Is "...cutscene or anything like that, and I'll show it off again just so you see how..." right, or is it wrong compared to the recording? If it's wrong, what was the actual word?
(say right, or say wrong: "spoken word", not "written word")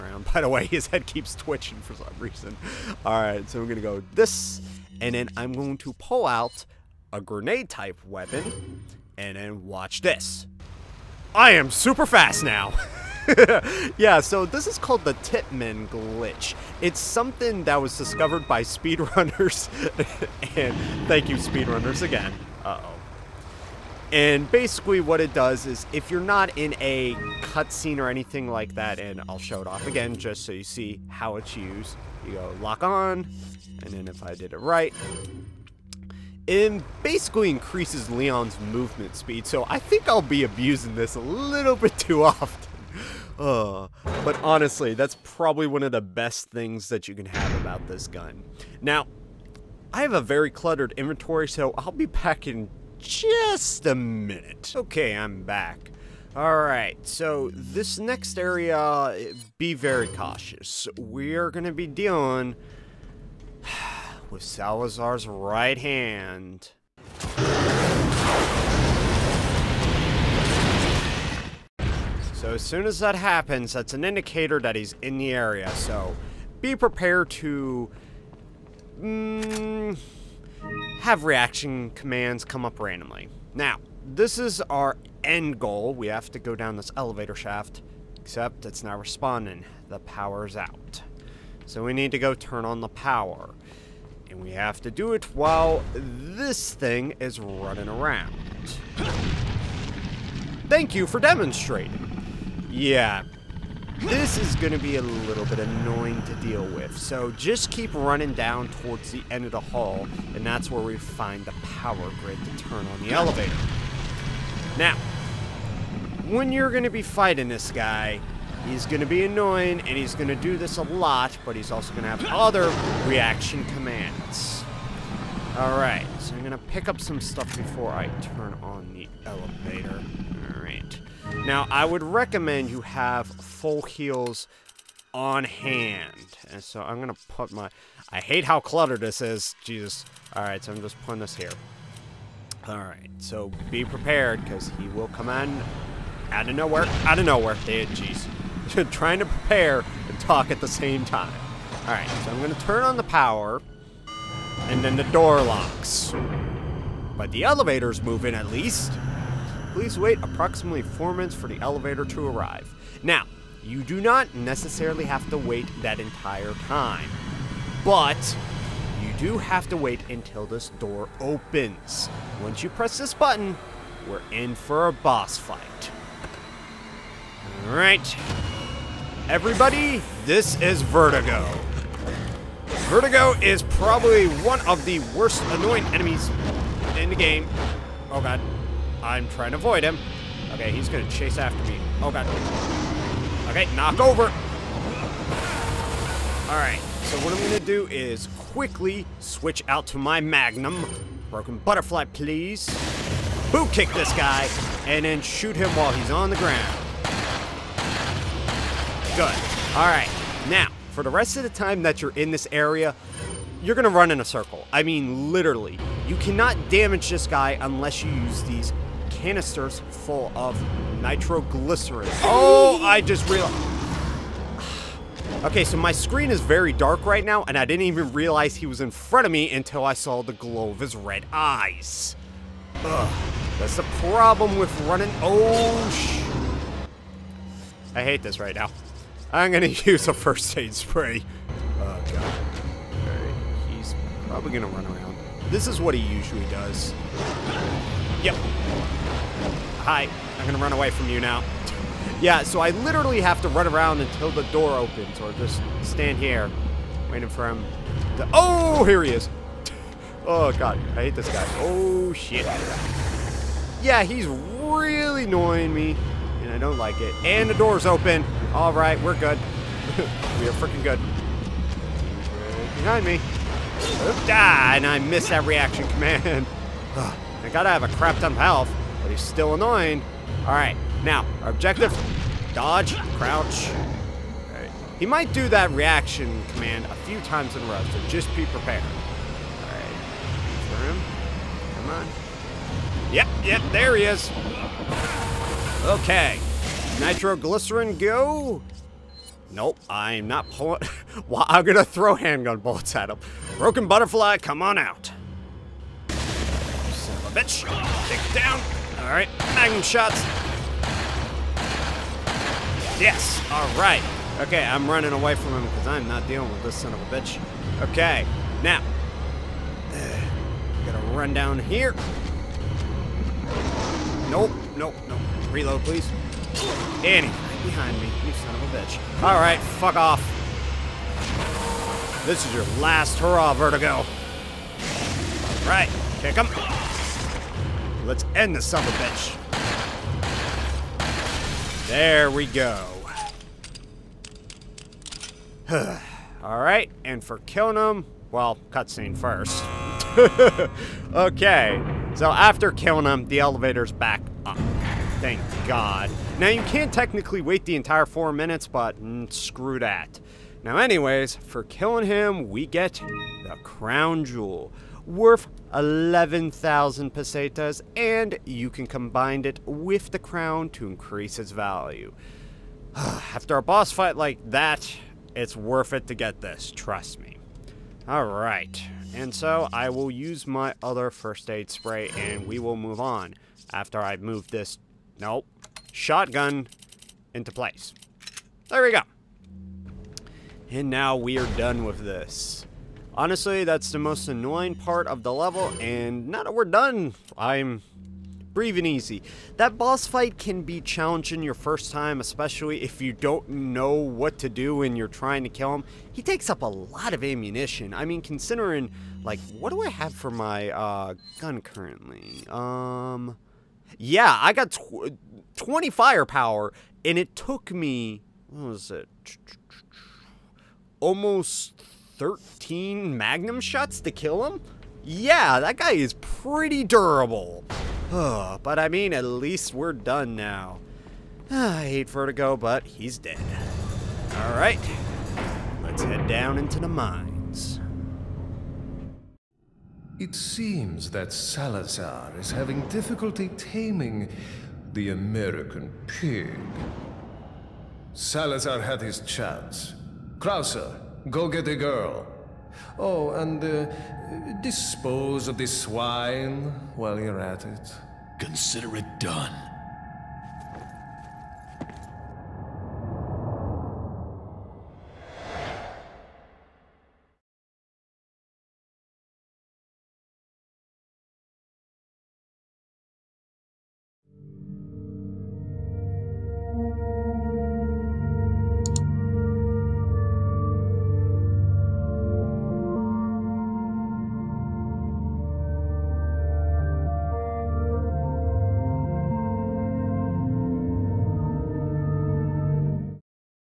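right.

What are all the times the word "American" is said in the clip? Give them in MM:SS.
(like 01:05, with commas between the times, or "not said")
07:25.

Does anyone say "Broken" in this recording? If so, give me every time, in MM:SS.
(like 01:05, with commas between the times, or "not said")
03:21, 05:03.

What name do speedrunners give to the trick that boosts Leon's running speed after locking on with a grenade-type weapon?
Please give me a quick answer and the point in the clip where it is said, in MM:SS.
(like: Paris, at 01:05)
Titman glitch, at 00:15.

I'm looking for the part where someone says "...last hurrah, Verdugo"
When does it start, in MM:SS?
05:32.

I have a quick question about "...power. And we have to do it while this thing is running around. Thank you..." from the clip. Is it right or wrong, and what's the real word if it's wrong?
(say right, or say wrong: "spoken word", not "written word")
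right.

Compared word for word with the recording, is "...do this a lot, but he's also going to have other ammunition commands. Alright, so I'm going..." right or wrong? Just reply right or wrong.
wrong.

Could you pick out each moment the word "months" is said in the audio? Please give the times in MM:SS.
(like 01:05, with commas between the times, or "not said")
not said.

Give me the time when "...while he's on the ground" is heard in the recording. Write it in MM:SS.
03:25.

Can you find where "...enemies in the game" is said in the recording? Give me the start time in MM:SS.
03:05.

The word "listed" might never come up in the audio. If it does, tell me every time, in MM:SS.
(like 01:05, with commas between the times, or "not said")
not said.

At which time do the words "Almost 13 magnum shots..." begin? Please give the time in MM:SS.
07:01.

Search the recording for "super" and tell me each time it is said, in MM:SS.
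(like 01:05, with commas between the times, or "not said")
00:11.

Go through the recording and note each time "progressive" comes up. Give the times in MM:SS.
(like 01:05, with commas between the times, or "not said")
not said.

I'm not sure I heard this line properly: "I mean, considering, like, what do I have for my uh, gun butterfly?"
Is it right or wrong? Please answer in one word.
wrong.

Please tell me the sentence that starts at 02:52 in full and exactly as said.
Once you press this button, we're in for a boss fight.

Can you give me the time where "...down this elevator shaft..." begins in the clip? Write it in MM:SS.
01:26.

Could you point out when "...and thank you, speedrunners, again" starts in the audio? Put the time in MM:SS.
00:20.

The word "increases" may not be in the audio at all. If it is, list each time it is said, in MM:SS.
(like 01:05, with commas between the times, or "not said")
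00:37, 06:10.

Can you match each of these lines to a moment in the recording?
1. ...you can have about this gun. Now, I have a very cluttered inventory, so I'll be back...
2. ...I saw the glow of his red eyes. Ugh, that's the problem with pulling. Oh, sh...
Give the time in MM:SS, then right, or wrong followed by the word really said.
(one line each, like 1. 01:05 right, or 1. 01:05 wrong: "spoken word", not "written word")
1. 00:47 right
2. 03:49 wrong: "running", not "pulling".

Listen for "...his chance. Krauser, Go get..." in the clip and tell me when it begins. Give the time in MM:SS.
07:29.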